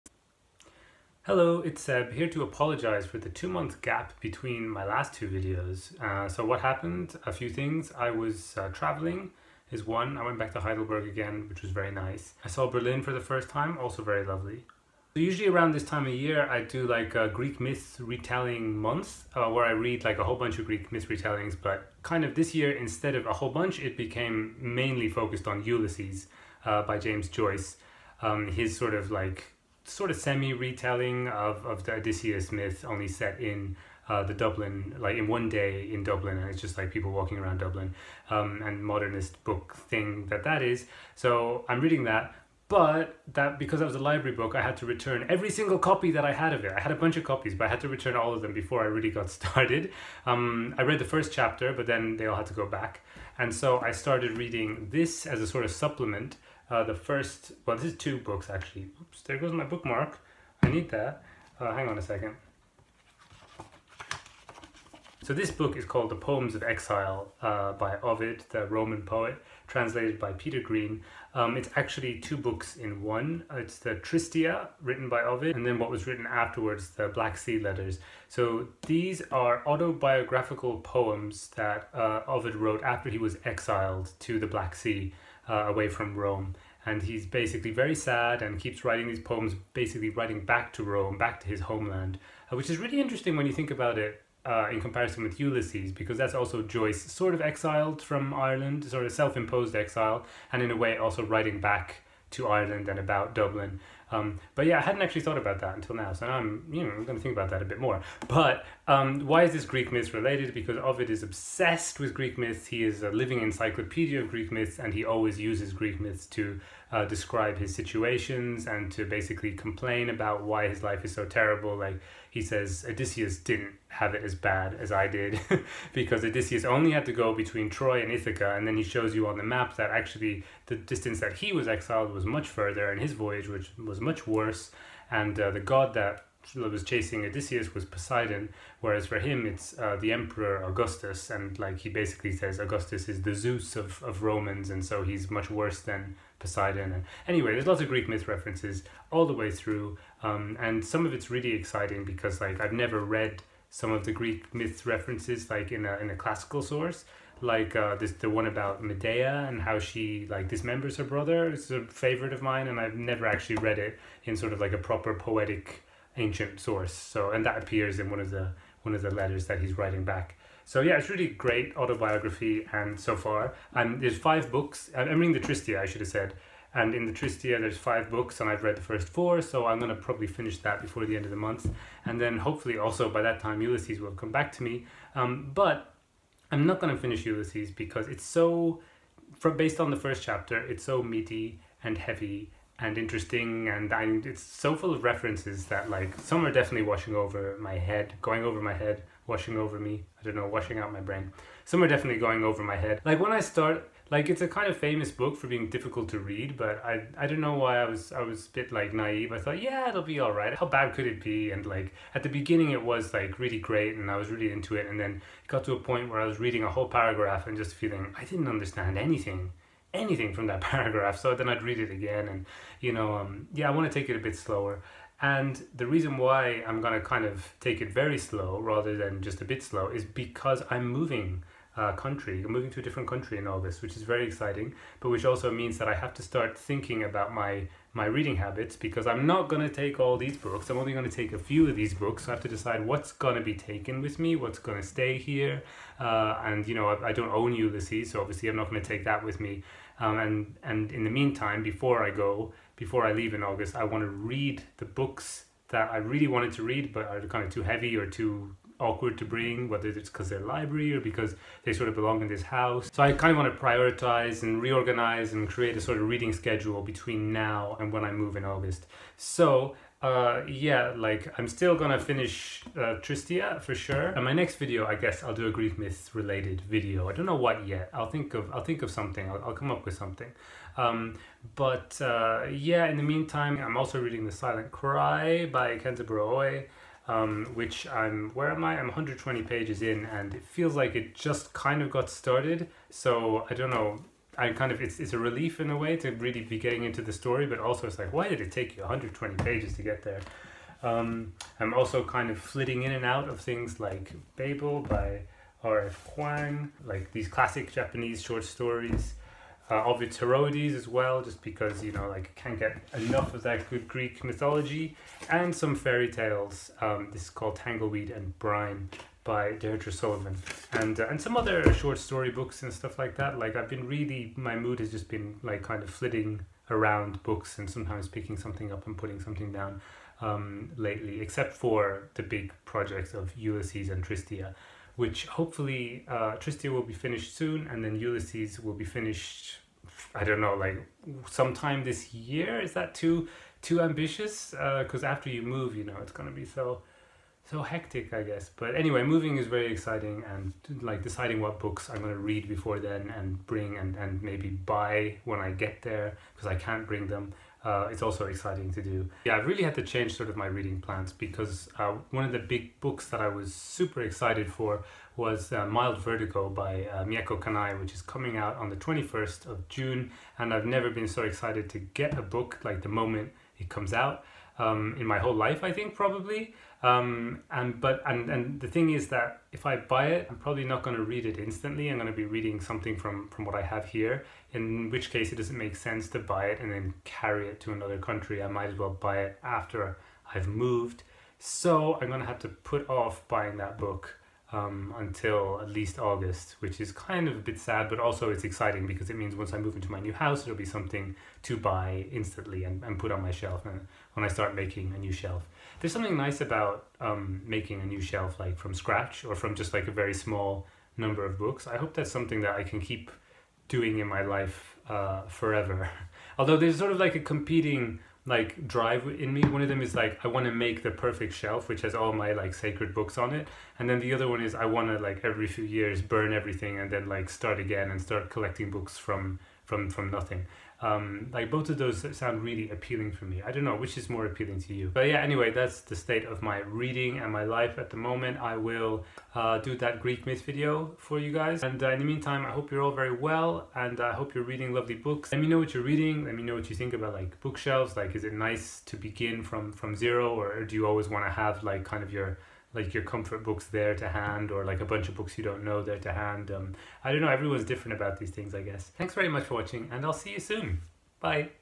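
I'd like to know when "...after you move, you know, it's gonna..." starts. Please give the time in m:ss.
5:45.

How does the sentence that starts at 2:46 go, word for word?
So and that appears in one of the one of the letters that he's writing back.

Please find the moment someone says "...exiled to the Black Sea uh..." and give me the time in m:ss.
1:23.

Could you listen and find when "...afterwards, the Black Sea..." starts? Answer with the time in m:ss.
1:16.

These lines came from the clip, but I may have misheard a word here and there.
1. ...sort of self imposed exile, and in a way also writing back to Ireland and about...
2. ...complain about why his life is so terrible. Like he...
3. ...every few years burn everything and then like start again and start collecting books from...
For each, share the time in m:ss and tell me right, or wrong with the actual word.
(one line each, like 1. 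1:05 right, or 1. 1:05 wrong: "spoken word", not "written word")
1. 1:38 right
2. 1:59 right
3. 7:05 right.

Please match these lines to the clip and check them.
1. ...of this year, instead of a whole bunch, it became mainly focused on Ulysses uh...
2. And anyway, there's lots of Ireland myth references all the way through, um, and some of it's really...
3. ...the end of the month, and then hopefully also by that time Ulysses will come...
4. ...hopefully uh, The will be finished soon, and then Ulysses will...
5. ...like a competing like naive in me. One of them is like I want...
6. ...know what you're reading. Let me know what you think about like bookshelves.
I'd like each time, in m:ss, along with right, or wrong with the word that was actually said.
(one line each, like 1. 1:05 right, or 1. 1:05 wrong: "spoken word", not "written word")
1. 0:22 right
2. 2:26 wrong: "Greek", not "Ireland"
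3. 3:01 right
4. 5:35 wrong: "Tristia", not "The"
5. 6:56 wrong: "drive", not "naive"
6. 7:25 right.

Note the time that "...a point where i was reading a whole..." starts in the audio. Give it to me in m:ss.
3:35.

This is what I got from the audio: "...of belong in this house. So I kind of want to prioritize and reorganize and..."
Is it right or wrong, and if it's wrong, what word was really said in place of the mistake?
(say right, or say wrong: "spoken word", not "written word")
right.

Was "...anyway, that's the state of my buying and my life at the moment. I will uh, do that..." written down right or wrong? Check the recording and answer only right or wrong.
wrong.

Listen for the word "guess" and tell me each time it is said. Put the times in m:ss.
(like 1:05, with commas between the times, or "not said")
4:34, 5:48, 7:38.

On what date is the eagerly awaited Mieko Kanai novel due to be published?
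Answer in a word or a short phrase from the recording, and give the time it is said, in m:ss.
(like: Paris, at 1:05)
21 June, at 6:08.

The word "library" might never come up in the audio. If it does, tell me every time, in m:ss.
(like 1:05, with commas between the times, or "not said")
0:43, 4:20.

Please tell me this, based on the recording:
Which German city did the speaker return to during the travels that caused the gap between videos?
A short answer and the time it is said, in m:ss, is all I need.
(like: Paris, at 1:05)
Heidelberg, at 0:10.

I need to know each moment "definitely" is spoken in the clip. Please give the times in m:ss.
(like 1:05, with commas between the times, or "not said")
3:16, 3:21.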